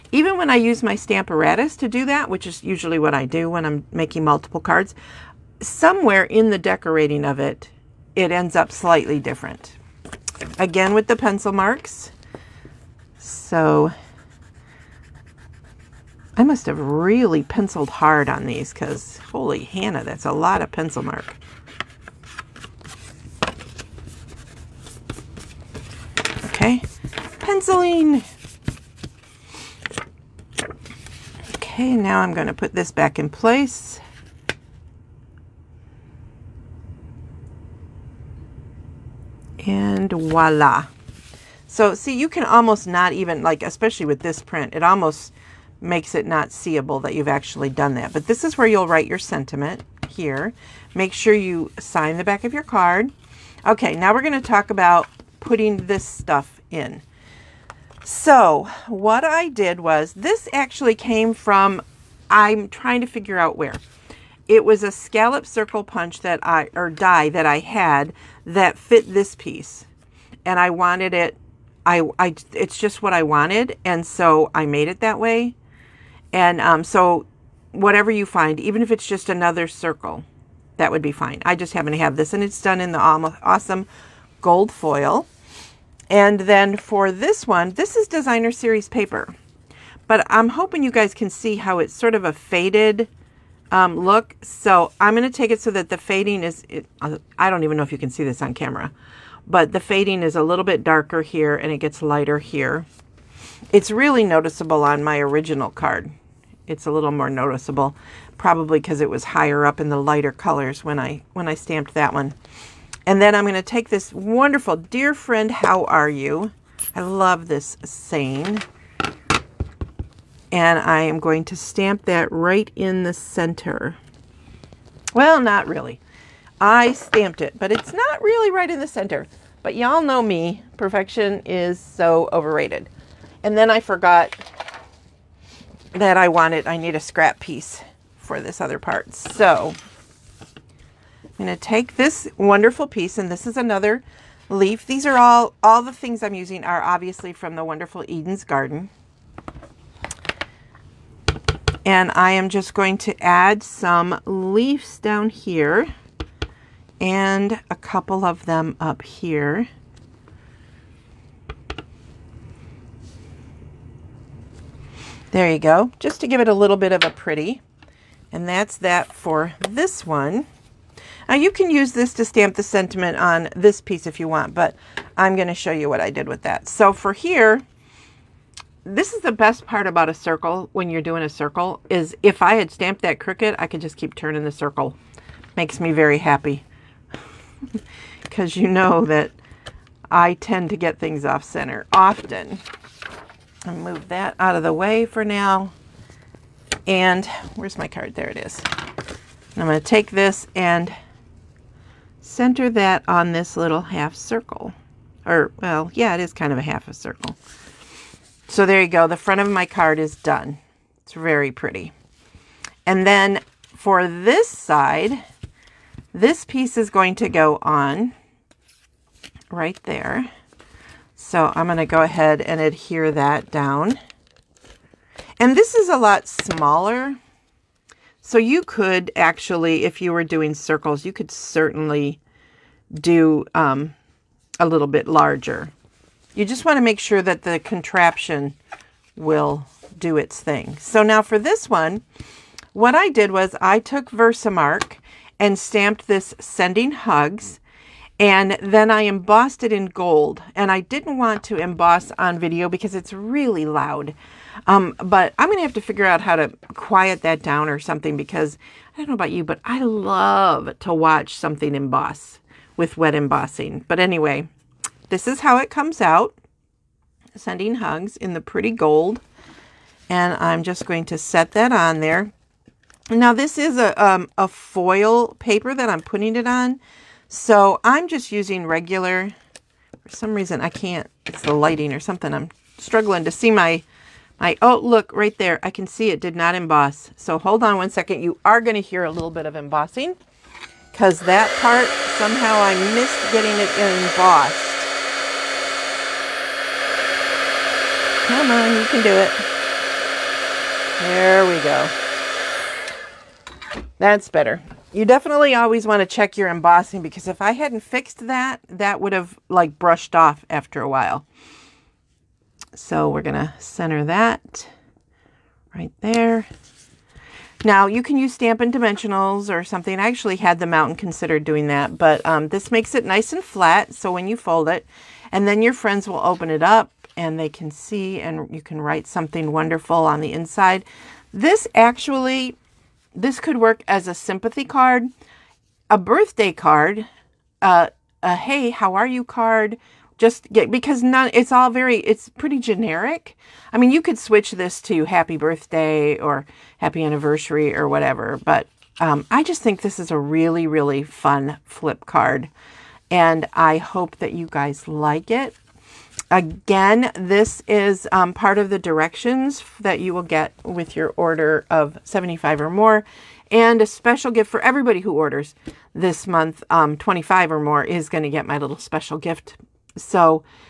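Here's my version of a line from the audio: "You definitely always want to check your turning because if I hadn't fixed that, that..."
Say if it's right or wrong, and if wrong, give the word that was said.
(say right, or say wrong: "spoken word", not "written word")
wrong: "embossing", not "turning".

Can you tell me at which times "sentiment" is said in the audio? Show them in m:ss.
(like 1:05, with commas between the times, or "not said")
0:49, 2:52.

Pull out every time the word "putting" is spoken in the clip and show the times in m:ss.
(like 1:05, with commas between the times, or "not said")
0:55, 4:36.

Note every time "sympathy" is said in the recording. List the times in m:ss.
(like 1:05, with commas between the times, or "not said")
5:34.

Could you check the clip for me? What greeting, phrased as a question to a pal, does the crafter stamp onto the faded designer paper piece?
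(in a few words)
Dear Friend, How Are You?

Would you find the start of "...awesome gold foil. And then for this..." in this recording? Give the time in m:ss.
1:22.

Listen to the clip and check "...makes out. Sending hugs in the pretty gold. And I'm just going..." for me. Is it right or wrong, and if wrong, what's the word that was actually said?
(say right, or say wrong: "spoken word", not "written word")
wrong: "comes", not "makes".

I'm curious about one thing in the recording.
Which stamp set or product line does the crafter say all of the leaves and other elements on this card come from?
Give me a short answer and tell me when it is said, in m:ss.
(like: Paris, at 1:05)
Eden's Garden, at 2:28.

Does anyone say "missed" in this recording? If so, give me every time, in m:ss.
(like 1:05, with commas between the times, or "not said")
4:52.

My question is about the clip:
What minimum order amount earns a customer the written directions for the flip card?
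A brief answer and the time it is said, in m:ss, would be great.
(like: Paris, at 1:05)
75, at 6:02.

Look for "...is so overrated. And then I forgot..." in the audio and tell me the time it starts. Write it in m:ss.
2:11.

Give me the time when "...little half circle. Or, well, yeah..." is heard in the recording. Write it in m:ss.
3:23.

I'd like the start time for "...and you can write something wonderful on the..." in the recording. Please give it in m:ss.
5:28.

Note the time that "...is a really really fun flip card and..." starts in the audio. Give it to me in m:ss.
5:49.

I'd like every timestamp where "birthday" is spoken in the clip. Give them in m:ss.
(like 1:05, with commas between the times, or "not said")
5:35, 5:45.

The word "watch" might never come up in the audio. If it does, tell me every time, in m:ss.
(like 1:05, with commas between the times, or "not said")
4:20.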